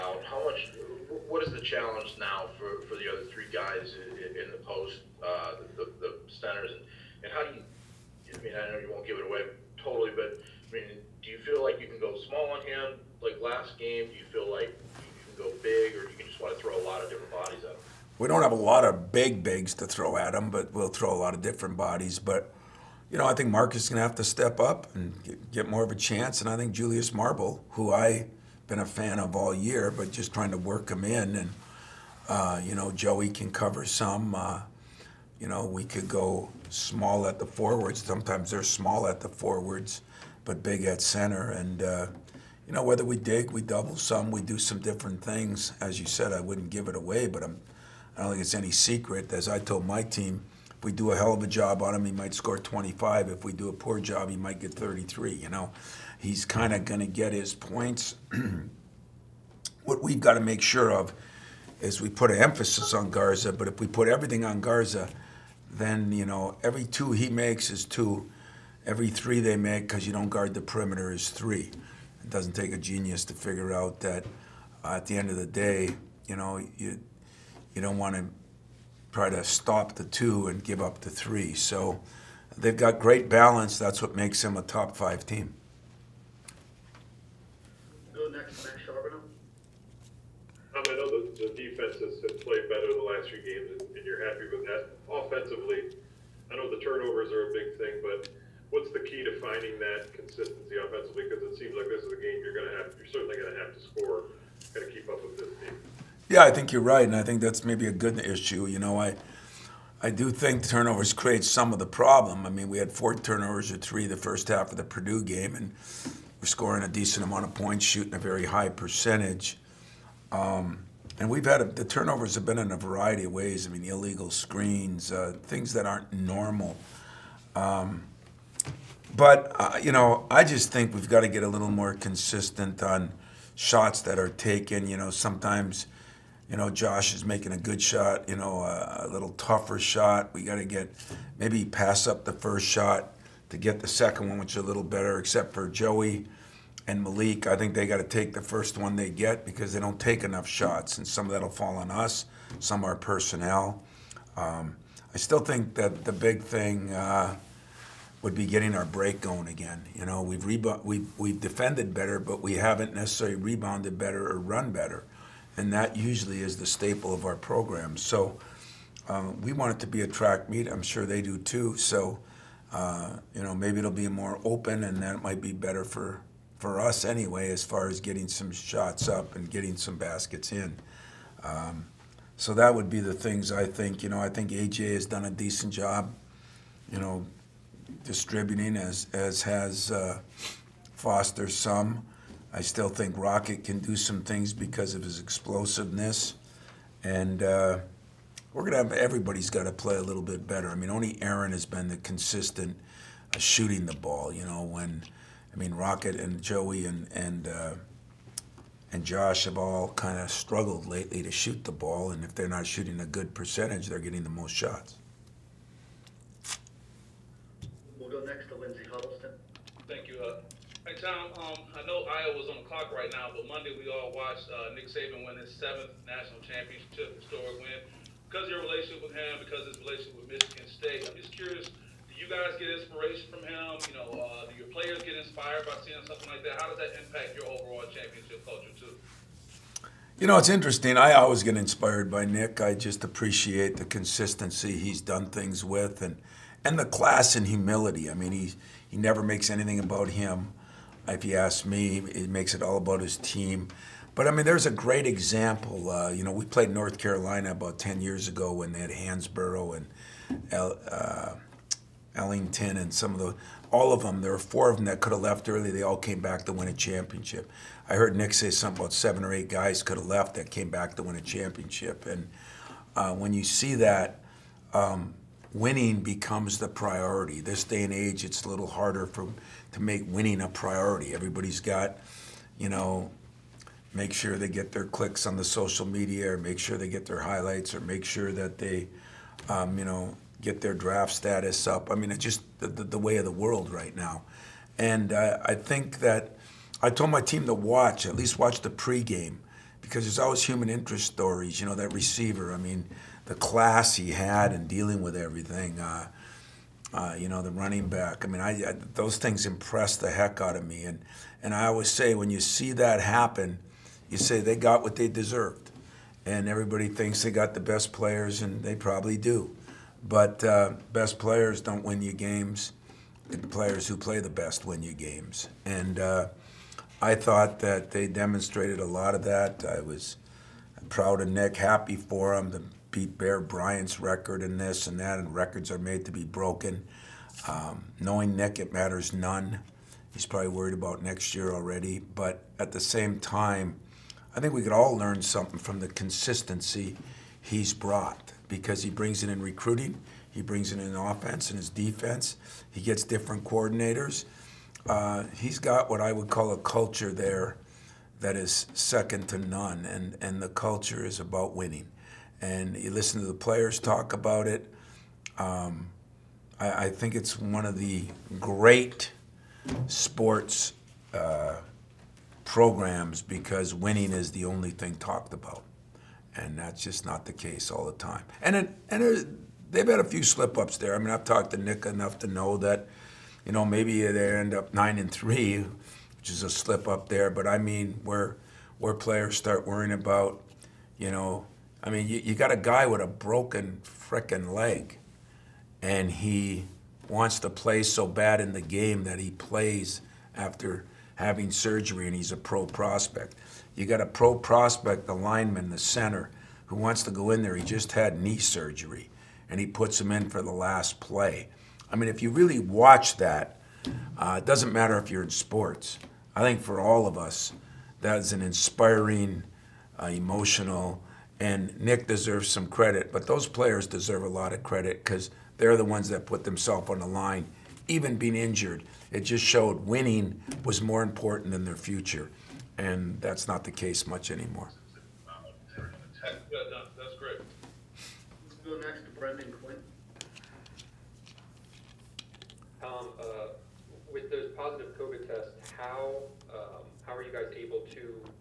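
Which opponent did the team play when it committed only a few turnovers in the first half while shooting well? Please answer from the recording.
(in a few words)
Purdue.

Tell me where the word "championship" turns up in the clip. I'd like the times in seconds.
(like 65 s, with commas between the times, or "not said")
226 s, 237 s, 266 s, 271 s.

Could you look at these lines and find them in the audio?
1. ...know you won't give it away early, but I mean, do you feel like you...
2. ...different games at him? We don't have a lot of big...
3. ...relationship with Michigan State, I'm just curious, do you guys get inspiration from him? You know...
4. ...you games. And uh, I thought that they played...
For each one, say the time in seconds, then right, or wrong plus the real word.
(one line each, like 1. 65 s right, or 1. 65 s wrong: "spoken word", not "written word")
1. 8 s wrong: "totally", not "early"
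2. 17 s wrong: "bodies", not "games"
3. 229 s right
4. 324 s wrong: "demonstrated", not "played".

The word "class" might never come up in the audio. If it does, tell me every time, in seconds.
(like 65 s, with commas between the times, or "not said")
246 s, 303 s.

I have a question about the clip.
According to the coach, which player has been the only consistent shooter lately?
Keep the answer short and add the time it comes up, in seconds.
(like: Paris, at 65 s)
Aaron, at 201 s.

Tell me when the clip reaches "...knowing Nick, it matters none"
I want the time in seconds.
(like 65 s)
337 s.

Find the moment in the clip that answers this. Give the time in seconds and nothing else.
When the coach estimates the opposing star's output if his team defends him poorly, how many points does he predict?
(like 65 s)
54 s.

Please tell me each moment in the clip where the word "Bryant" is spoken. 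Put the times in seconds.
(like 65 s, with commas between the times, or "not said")
333 s.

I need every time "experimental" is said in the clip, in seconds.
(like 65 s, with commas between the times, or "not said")
not said.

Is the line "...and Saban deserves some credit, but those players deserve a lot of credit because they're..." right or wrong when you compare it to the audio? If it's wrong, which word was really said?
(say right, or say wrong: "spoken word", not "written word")
wrong: "Nick", not "Saban".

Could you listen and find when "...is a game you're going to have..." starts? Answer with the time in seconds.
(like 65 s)
102 s.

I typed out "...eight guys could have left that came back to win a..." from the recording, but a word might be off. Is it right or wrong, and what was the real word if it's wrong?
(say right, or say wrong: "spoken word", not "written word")
right.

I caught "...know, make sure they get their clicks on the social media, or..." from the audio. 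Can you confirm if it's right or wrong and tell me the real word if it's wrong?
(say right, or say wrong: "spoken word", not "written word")
right.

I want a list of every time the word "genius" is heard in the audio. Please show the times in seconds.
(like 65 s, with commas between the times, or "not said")
72 s.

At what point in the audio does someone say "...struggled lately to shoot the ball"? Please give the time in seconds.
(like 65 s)
210 s.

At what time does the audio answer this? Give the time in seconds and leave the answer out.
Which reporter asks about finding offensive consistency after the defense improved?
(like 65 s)
88 s.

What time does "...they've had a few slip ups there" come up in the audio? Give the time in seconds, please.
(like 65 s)
379 s.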